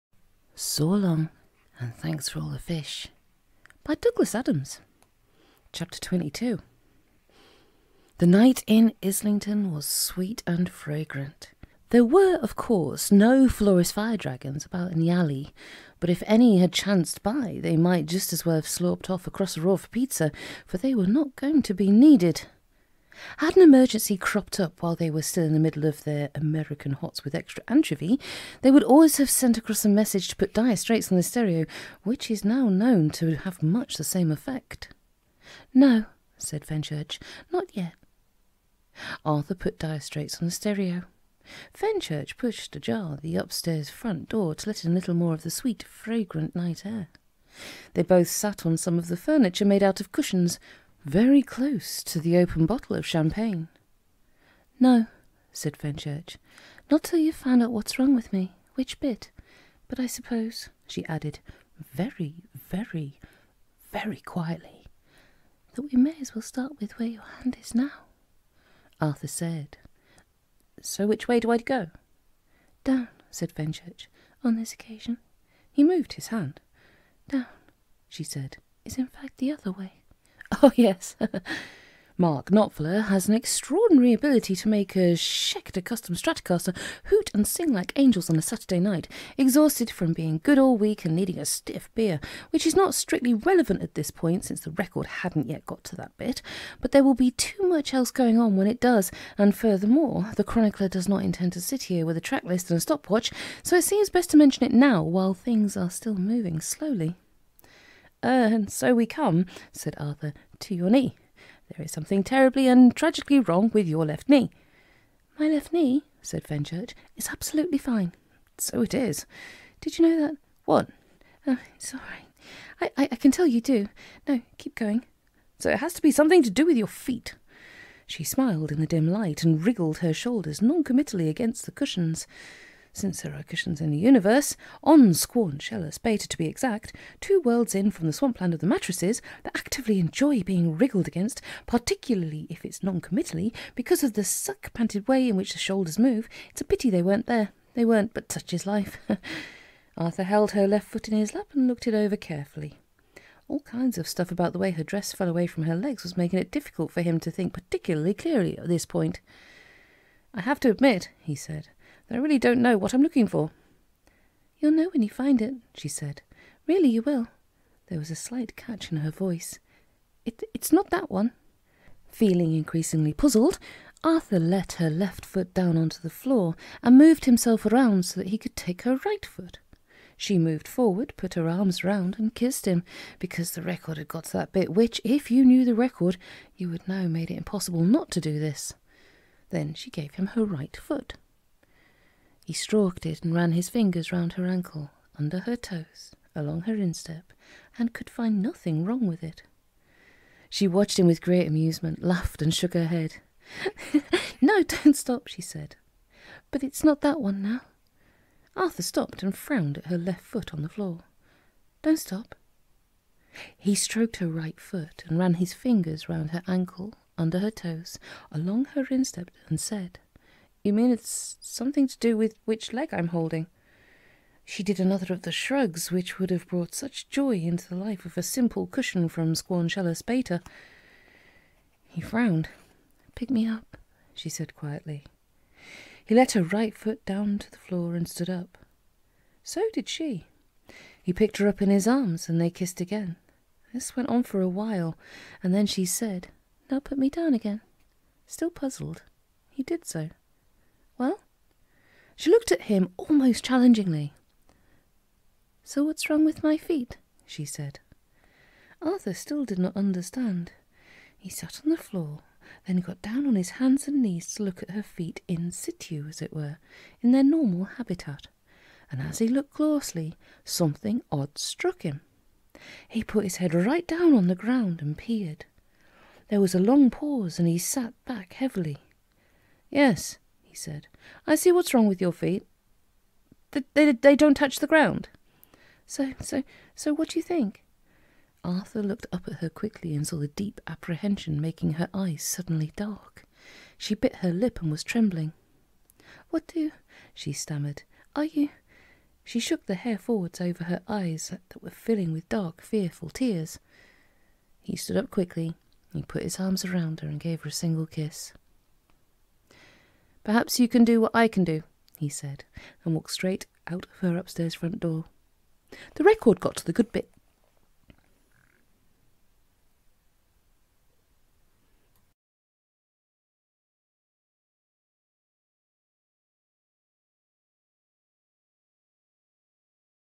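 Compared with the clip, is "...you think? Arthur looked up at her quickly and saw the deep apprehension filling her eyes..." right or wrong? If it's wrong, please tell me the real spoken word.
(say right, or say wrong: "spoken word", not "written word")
wrong: "making", not "filling".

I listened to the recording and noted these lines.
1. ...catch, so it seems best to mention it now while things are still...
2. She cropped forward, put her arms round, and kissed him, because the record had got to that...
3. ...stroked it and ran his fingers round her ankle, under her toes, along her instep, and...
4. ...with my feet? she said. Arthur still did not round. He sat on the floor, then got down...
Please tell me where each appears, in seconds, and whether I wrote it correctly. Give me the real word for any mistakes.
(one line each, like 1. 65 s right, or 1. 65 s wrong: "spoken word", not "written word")
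1. 102 s wrong: "stopwatch", not "catch"
2. 180 s wrong: "moved", not "cropped"
3. 192 s right
4. 256 s wrong: "understand", not "round".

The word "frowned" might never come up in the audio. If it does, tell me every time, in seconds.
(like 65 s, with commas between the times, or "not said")
209 s, 232 s.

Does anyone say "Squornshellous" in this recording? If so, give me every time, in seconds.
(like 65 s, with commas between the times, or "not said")
135 s, 229 s.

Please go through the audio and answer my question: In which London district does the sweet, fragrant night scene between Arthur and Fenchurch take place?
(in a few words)
Islington.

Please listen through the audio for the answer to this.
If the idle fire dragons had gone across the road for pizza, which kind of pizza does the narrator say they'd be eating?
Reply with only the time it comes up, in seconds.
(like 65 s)
26 s.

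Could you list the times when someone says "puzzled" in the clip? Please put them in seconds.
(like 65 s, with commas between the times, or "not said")
173 s, 248 s.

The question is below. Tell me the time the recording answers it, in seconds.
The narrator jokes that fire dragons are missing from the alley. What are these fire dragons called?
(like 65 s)
13 s.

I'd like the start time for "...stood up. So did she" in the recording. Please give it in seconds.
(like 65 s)
238 s.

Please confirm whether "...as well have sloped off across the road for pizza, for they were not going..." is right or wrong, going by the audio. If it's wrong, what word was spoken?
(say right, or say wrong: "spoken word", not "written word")
right.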